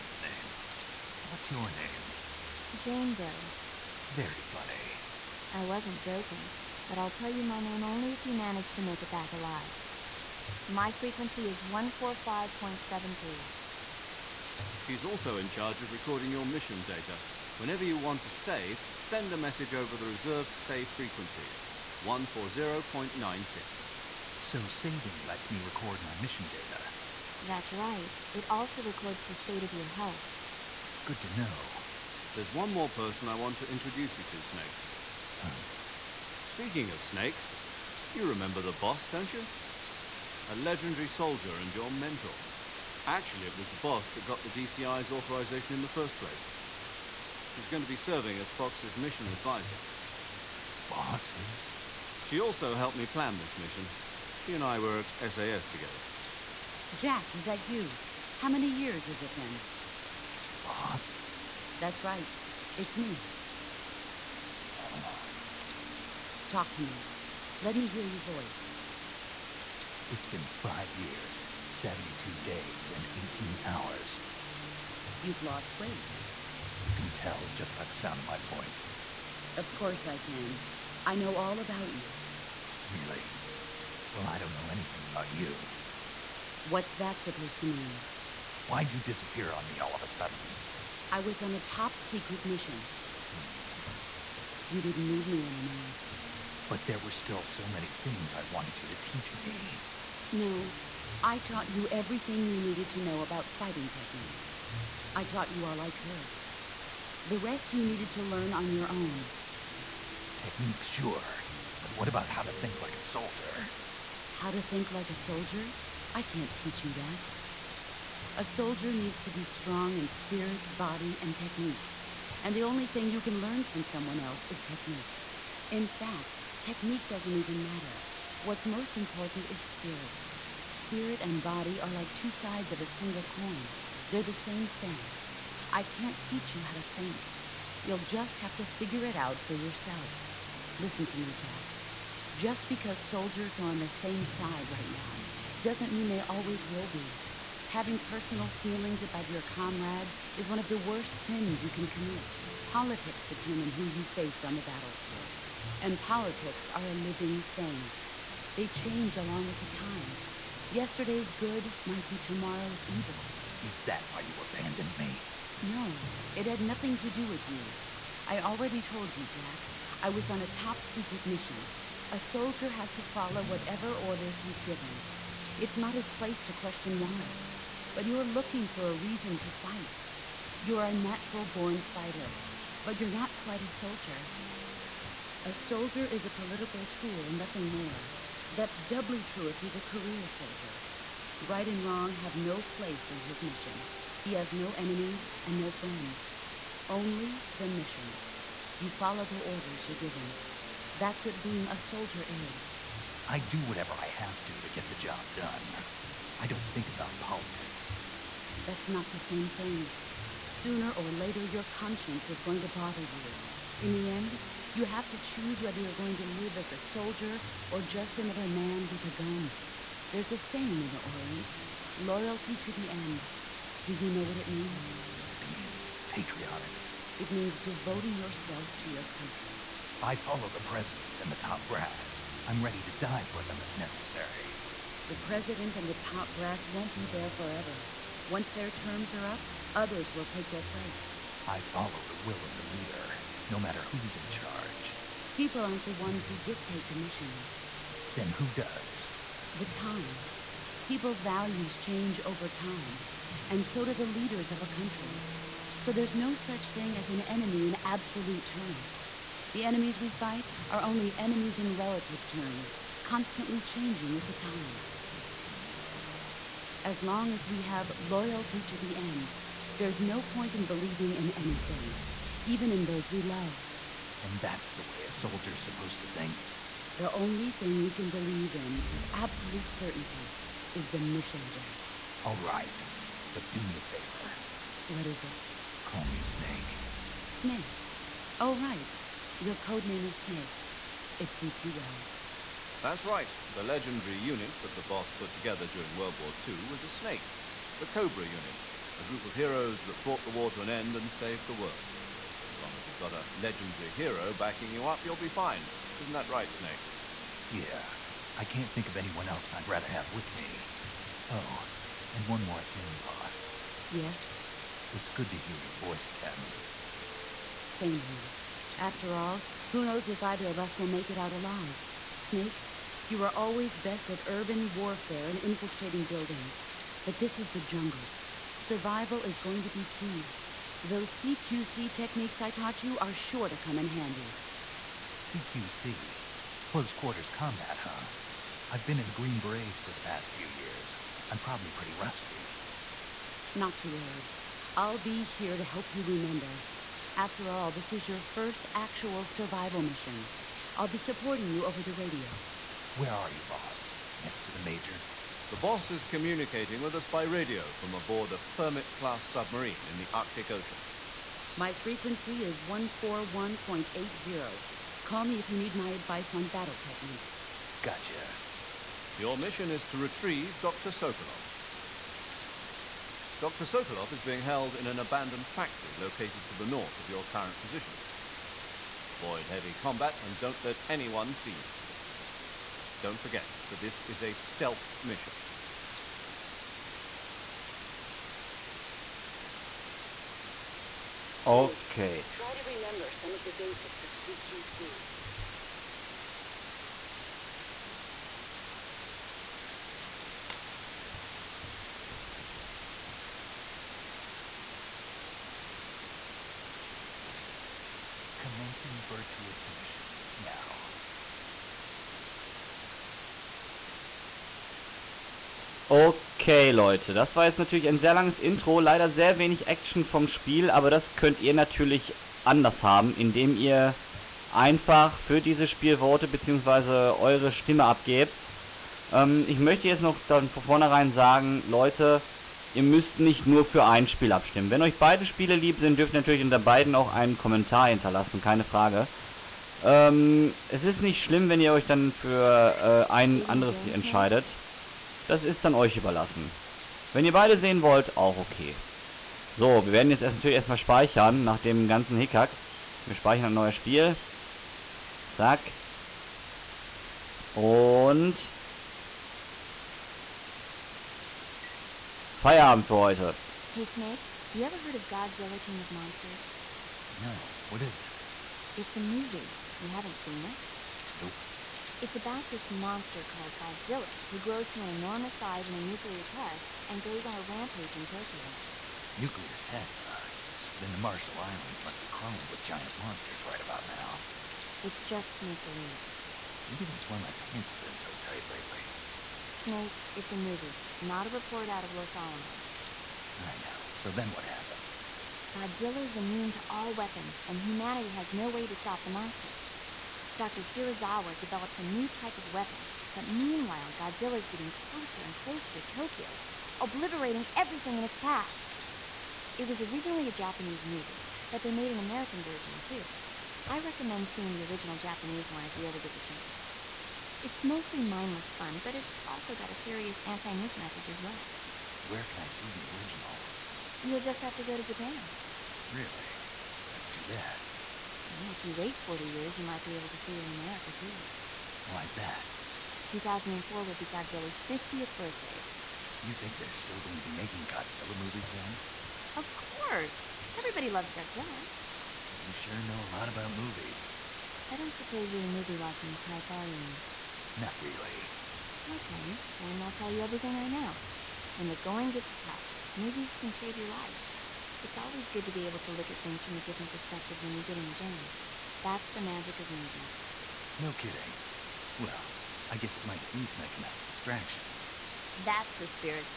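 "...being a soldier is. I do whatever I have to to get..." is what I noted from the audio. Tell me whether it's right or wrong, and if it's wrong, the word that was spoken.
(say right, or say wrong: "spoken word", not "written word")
right.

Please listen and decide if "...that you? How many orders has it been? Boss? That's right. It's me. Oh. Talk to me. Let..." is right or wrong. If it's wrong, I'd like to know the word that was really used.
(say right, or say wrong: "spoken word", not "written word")
wrong: "years", not "orders".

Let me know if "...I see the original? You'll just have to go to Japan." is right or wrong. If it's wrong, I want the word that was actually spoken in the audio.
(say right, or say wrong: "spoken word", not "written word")
right.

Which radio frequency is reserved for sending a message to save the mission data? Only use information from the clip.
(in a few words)
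140.96.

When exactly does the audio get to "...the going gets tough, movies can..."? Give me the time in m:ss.
9:11.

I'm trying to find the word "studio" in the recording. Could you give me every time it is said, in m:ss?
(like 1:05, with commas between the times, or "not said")
not said.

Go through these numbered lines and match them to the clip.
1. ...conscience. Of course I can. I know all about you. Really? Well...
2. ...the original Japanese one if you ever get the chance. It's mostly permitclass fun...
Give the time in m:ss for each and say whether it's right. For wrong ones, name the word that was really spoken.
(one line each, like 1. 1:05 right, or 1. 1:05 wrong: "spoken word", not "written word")
1. 1:18 wrong: "voice", not "conscience"
2. 8:34 wrong: "mindless", not "permitclass".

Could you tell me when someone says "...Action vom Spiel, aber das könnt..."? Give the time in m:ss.
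6:59.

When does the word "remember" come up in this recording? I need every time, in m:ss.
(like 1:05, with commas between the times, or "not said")
0:38, 5:46, 6:32.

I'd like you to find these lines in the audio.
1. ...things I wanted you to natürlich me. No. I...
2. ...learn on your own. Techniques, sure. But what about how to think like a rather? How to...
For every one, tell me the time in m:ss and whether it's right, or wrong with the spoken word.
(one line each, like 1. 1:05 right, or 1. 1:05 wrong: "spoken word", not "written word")
1. 1:37 wrong: "teach", not "natürlich"
2. 1:48 wrong: "soldier", not "rather".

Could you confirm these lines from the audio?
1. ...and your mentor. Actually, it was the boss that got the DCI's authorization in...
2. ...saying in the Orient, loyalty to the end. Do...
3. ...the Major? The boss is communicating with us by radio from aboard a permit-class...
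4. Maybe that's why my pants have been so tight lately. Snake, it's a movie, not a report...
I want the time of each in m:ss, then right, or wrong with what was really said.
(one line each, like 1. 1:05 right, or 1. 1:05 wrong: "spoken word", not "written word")
1. 0:41 right
2. 3:40 right
3. 5:54 right
4. 8:06 right.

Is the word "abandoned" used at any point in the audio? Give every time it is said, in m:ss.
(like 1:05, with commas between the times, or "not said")
2:44, 6:14.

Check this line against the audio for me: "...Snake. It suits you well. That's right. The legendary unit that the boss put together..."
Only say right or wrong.
right.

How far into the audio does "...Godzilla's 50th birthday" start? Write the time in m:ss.
8:54.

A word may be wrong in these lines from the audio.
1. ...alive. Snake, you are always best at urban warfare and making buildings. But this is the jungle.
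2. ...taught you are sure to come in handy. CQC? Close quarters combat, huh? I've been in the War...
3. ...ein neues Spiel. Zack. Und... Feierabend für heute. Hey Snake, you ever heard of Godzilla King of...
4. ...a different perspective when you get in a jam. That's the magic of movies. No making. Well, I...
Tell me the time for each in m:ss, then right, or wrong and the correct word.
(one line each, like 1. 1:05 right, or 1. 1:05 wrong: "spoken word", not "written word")
1. 5:21 wrong: "infiltrating", not "making"
2. 5:32 wrong: "Green", not "War"
3. 7:33 right
4. 9:16 wrong: "kidding", not "making".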